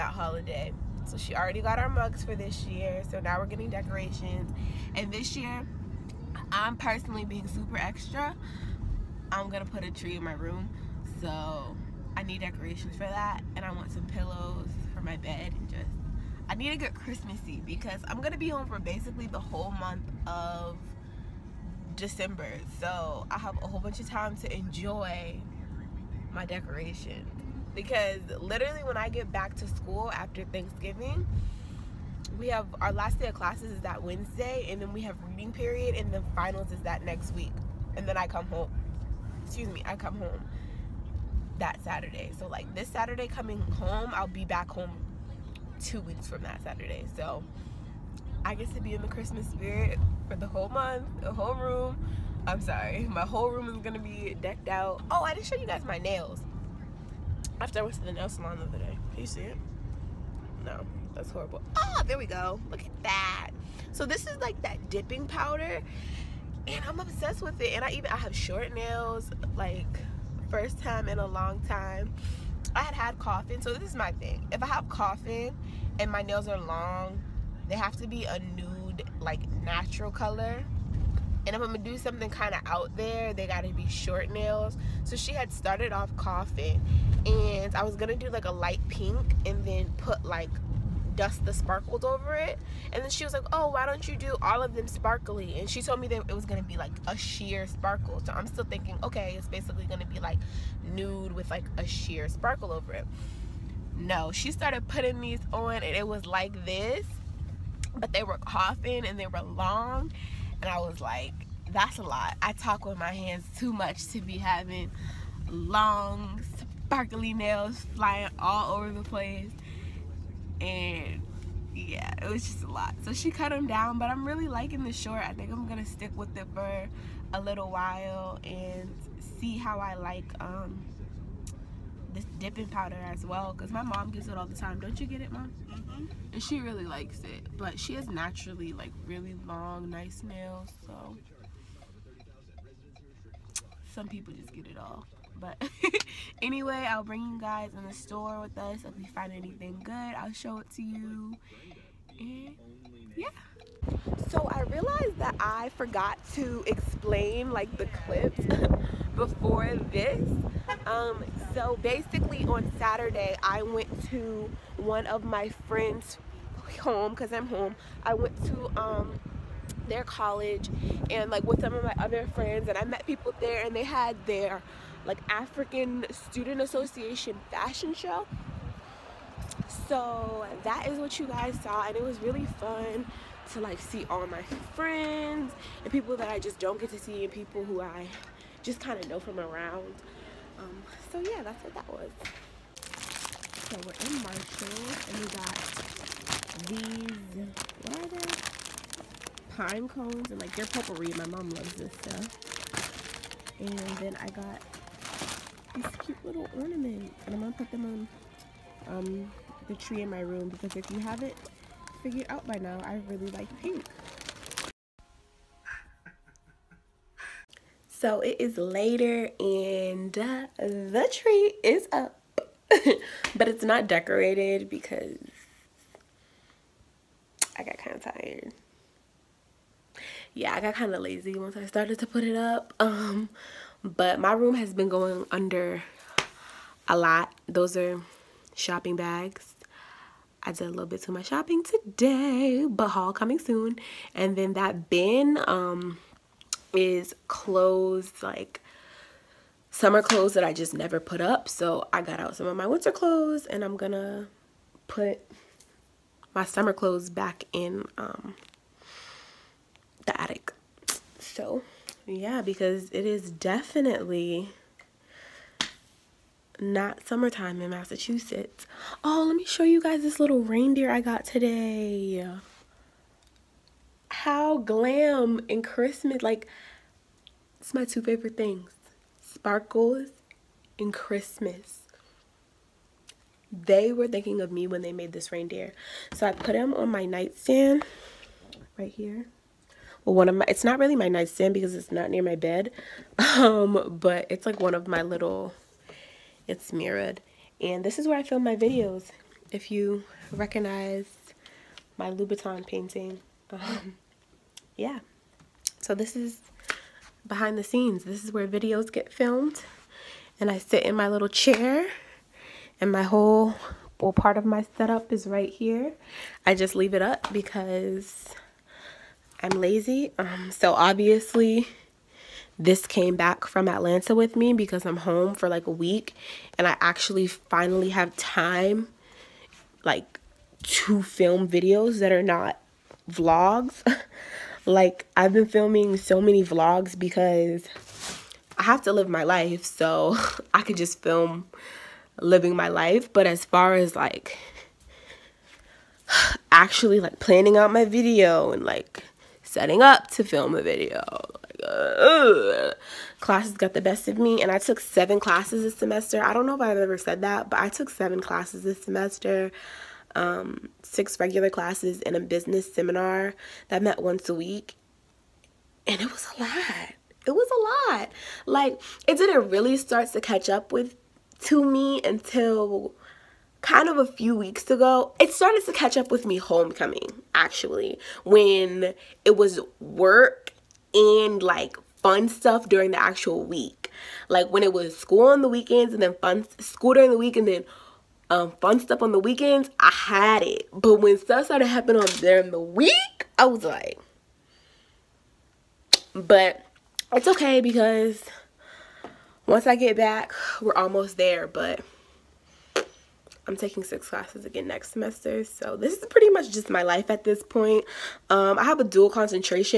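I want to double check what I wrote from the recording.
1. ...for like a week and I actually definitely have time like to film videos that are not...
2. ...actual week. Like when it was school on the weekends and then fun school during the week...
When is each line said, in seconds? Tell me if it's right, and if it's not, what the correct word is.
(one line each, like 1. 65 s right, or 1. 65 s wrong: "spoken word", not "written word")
1. 325 s wrong: "finally", not "definitely"
2. 383 s right.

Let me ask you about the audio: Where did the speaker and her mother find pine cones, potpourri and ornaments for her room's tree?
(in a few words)
Marshall.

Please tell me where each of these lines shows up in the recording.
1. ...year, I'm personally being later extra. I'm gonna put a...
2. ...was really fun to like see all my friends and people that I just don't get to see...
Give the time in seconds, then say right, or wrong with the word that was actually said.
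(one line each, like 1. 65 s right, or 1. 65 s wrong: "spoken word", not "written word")
1. 5 s wrong: "super", not "later"
2. 182 s right.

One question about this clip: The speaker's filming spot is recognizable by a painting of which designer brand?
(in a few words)
Louboutin.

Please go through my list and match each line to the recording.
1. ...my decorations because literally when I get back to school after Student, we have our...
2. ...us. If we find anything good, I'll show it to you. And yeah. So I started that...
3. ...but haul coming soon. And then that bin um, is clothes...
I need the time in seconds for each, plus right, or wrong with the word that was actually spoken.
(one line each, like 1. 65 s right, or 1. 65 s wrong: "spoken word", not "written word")
1. 26 s wrong: "Thanksgiving", not "Student"
2. 148 s wrong: "realized", not "started"
3. 242 s right.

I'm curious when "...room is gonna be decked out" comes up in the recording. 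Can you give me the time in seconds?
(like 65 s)
53 s.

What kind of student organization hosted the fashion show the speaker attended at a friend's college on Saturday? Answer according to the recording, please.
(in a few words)
African Student Association.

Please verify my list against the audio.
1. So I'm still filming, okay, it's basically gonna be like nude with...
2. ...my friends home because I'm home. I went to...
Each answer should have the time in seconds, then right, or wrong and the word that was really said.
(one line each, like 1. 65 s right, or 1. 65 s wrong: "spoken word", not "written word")
1. 98 s wrong: "thinking", not "filming"
2. 165 s right.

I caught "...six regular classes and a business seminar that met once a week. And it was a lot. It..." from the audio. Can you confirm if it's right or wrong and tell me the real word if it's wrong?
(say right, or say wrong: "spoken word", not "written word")
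right.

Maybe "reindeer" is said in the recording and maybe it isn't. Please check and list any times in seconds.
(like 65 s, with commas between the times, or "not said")
270 s, 285 s.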